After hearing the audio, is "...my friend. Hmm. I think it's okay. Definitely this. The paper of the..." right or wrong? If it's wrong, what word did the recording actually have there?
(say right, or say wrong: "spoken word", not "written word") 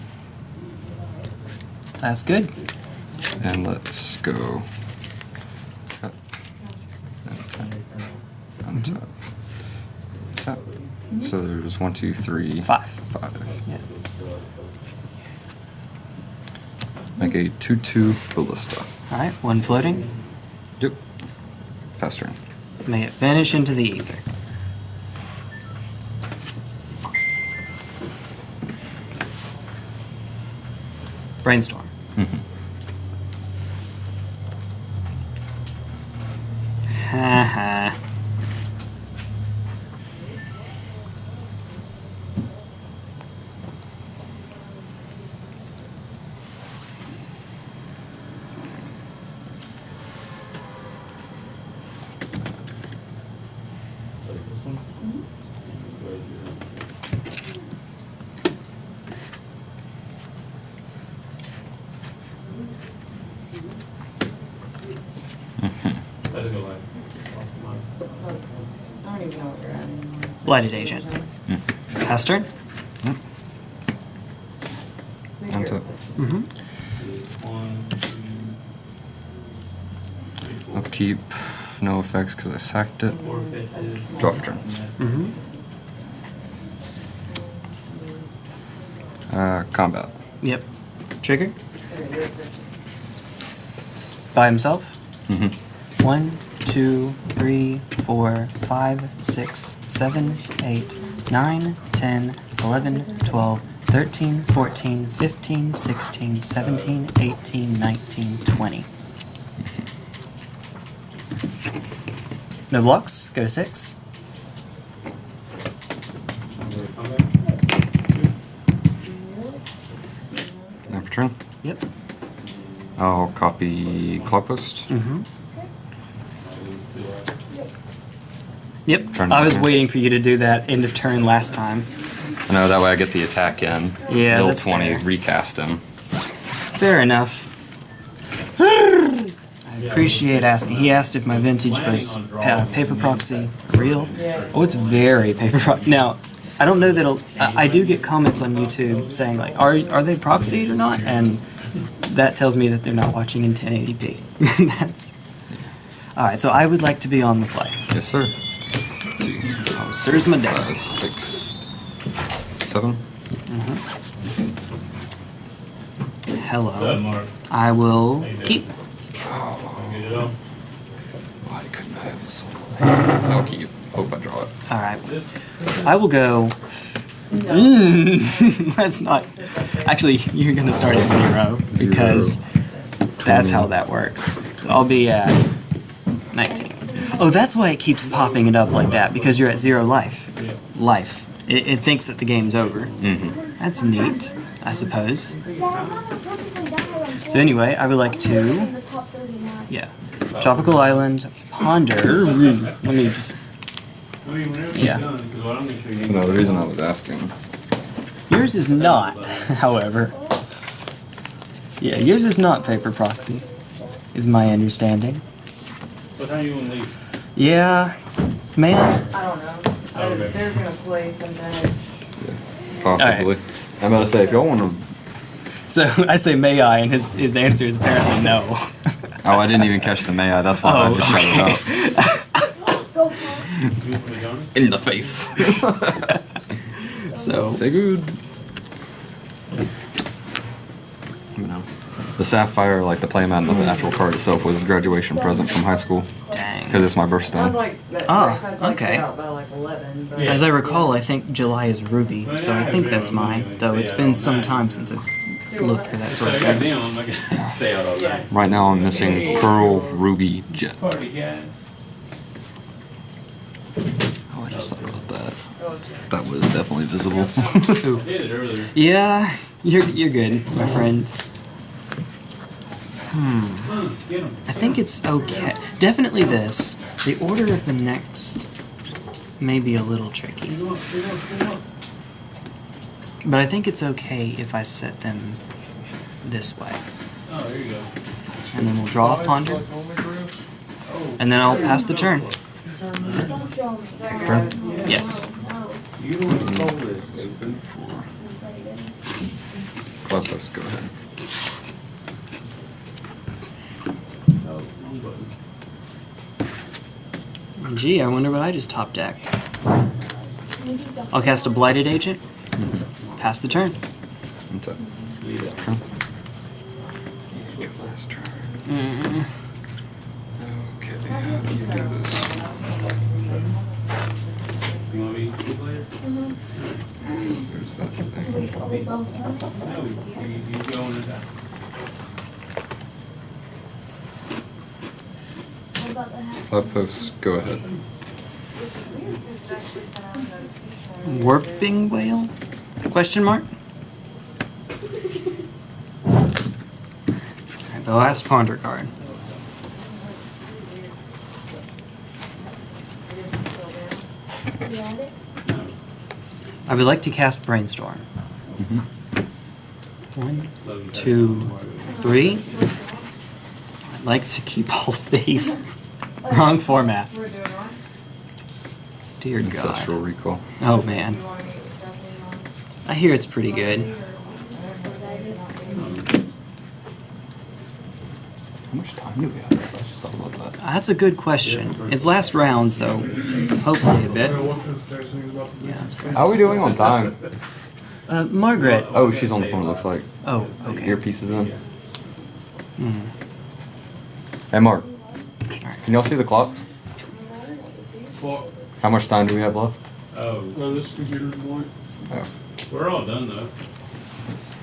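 wrong: "order", not "paper".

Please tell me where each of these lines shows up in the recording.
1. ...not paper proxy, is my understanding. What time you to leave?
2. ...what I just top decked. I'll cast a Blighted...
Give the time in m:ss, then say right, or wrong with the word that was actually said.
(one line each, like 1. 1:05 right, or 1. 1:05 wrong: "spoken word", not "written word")
1. 3:32 right
2. 5:08 right.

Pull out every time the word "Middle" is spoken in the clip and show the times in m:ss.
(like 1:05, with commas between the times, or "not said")
2:14.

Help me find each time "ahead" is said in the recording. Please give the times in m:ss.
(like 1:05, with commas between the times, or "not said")
5:00, 5:37.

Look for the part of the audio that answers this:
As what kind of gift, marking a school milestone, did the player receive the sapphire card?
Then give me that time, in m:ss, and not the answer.
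4:04.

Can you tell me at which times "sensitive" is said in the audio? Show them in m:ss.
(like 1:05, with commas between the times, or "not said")
not said.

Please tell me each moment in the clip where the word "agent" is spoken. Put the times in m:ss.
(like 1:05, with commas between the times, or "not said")
1:10, 5:11.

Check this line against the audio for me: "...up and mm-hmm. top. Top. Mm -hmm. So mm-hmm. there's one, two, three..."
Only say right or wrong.
right.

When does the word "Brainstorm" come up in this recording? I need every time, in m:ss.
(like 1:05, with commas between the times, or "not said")
0:31, 5:57.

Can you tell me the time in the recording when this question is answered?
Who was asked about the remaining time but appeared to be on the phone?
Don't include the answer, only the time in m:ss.
6:28.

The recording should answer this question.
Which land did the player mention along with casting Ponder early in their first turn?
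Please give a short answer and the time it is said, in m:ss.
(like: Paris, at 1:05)
Tropical Island, at 3:20.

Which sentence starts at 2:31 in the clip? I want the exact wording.
And that tells me that they're not watching in 1080p.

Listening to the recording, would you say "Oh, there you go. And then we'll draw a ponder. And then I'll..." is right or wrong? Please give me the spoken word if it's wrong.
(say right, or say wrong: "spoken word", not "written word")
right.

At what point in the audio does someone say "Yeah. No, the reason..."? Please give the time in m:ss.
3:24.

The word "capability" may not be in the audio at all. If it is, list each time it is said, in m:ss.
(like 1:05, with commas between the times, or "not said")
not said.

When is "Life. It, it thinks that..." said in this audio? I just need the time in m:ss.
3:10.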